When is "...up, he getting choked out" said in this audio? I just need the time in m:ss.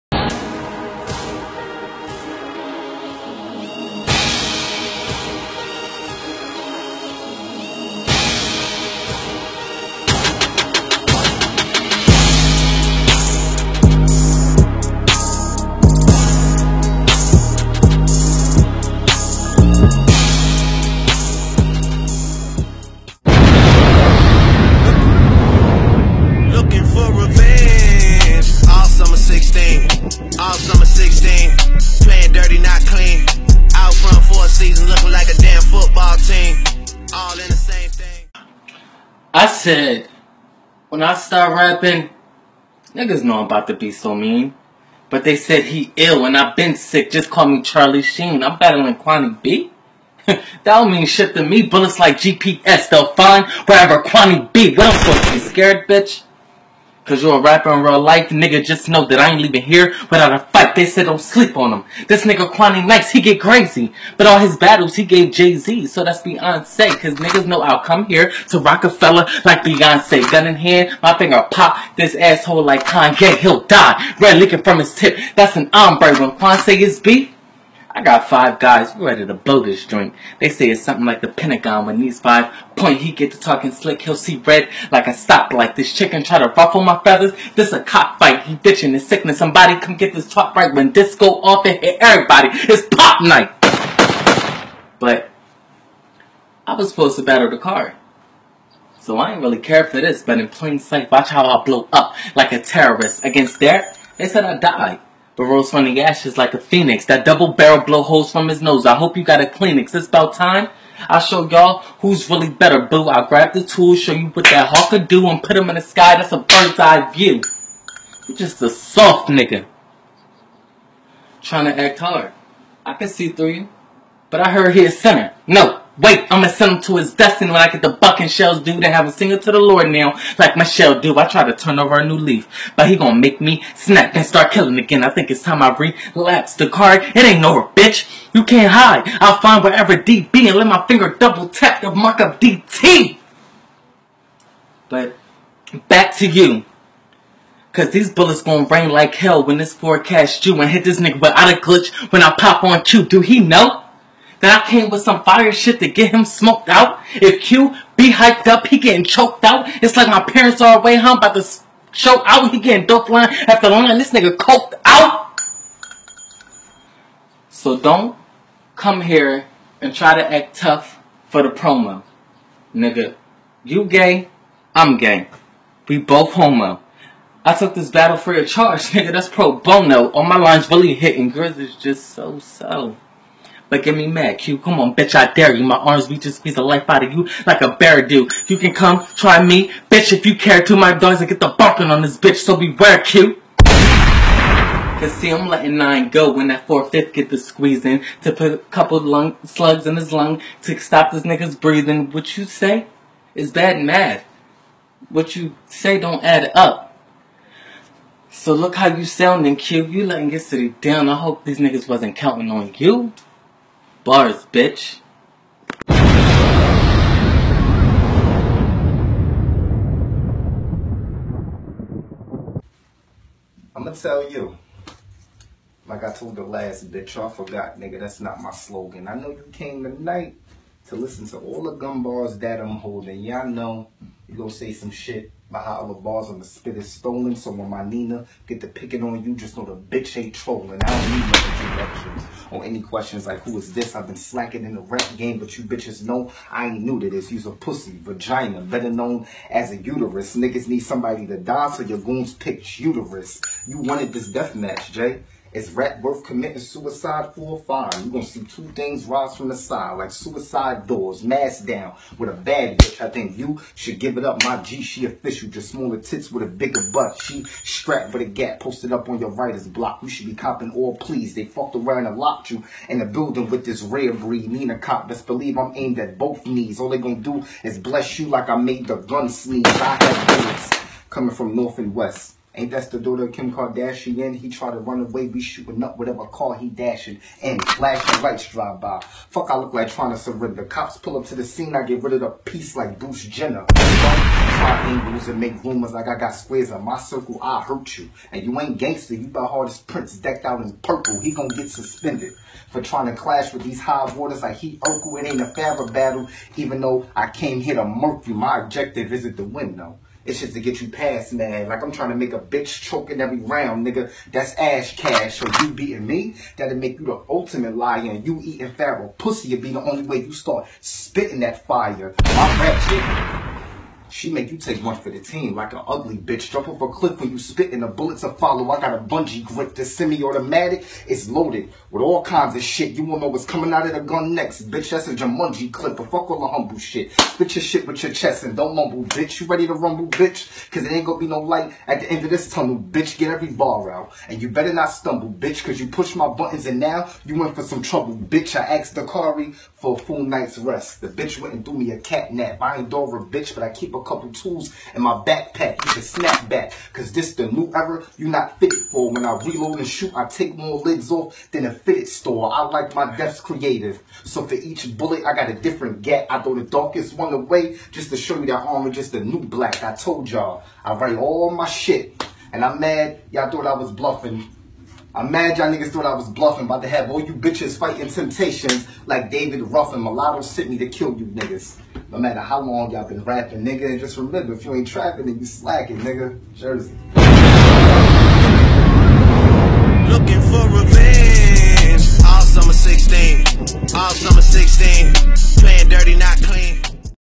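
2:38.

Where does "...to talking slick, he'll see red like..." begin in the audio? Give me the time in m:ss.
1:23.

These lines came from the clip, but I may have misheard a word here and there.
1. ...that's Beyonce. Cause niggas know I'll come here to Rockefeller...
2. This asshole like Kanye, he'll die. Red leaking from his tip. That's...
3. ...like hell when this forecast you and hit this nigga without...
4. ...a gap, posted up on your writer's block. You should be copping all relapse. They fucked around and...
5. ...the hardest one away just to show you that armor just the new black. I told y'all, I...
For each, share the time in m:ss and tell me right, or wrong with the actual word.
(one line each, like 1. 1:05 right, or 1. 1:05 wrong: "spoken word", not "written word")
1. 1:06 right
2. 1:11 right
3. 2:28 right
4. 4:28 wrong: "please", not "relapse"
5. 6:06 wrong: "darkest", not "hardest".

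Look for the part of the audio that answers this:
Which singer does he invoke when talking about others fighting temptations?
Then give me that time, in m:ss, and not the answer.
6:19.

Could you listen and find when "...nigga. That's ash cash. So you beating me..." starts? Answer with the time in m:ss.
5:13.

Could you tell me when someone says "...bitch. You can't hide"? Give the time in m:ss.
2:17.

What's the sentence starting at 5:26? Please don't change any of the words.
Jump off a cliff when you spit and the bullets are follow.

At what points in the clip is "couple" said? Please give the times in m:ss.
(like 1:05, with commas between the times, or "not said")
3:18, 5:54.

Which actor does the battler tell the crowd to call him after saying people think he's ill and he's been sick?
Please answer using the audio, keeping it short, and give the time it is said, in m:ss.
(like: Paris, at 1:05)
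Charlie Sheen, at 0:47.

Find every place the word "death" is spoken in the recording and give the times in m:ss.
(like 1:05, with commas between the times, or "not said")
4:14, 6:03.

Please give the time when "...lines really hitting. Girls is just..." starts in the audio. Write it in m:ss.
3:00.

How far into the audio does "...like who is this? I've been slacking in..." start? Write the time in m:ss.
4:03.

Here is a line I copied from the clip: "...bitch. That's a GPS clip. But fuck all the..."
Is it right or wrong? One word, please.
wrong.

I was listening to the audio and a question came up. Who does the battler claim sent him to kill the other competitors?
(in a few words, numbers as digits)
Mulatto.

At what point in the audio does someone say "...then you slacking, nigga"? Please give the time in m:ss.
6:25.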